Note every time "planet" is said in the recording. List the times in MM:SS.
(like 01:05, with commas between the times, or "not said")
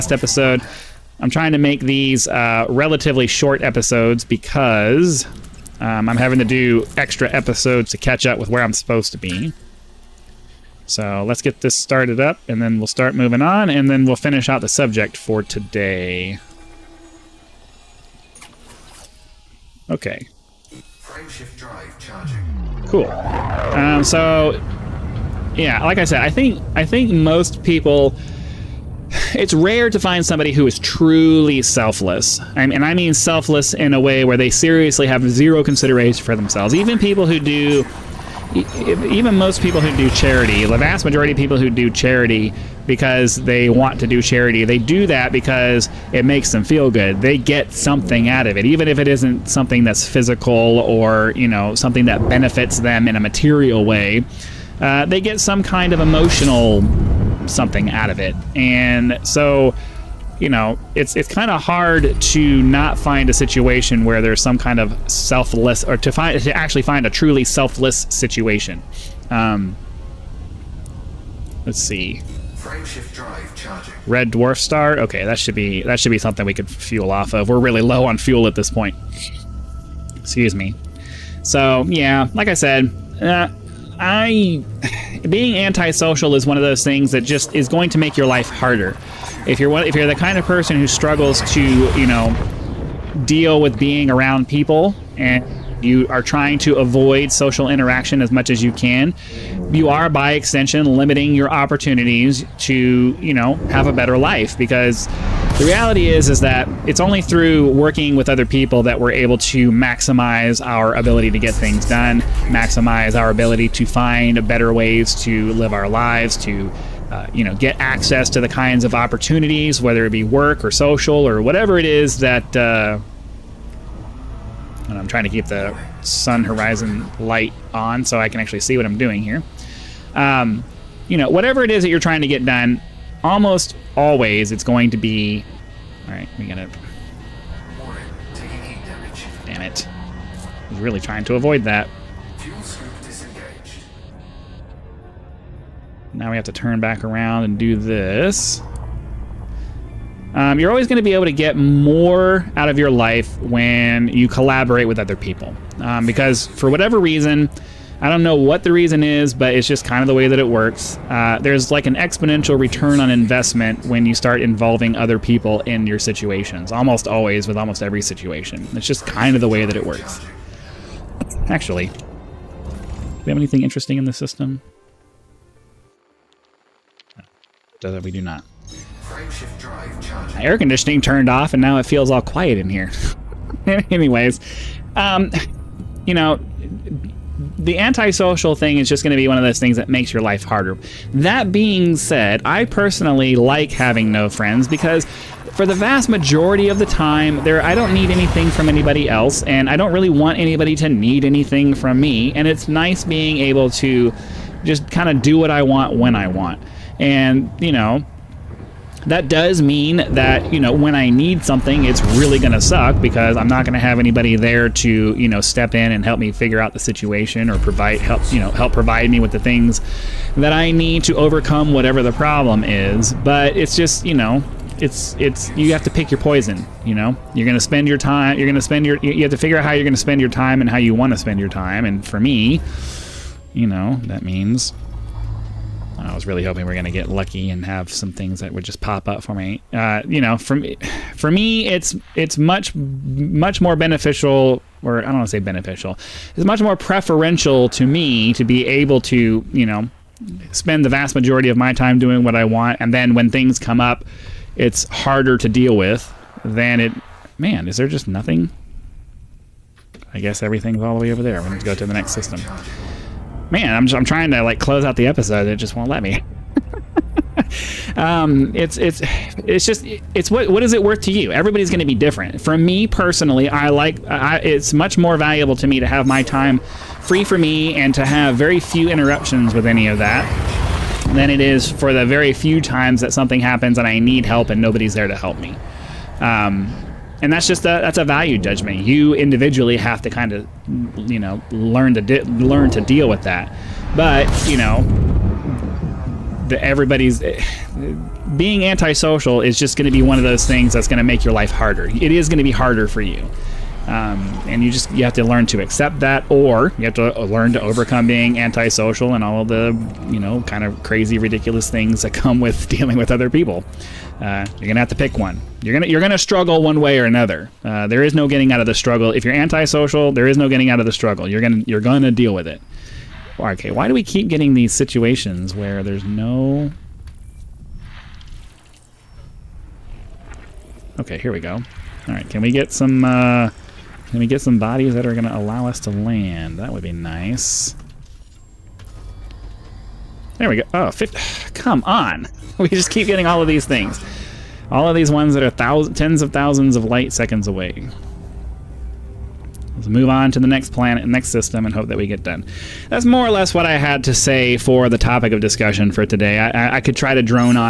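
05:50.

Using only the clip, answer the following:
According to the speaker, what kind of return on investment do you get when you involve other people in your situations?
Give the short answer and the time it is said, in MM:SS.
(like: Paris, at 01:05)
Exponential, at 02:41.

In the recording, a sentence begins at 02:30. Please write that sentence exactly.
Um, you're always going to be able to get more out of your life when you collaborate with other people.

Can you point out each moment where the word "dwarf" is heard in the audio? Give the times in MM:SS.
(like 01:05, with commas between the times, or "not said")
01:14.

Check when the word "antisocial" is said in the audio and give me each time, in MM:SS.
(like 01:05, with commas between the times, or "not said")
01:25, 03:07, 04:58, 05:08, 05:19.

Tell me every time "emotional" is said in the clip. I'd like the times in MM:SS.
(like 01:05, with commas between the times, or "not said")
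00:55.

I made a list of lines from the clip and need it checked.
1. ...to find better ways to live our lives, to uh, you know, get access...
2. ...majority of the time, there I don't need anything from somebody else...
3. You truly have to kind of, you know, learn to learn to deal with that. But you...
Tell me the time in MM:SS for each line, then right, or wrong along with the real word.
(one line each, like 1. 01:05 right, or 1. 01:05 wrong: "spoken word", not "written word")
1. 01:53 right
2. 03:16 wrong: "anybody", not "somebody"
3. 04:48 wrong: "individually", not "truly".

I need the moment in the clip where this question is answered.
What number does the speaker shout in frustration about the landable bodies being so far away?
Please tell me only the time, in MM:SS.
05:40.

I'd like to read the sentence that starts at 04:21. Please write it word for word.
We need to go to the next system man, I'm, I'm trying to like close out the episode.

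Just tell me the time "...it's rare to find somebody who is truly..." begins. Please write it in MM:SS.
00:29.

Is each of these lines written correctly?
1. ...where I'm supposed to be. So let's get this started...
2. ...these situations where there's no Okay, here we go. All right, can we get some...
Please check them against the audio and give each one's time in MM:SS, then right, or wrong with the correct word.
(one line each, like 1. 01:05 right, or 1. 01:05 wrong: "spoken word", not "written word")
1. 00:08 right
2. 05:24 right.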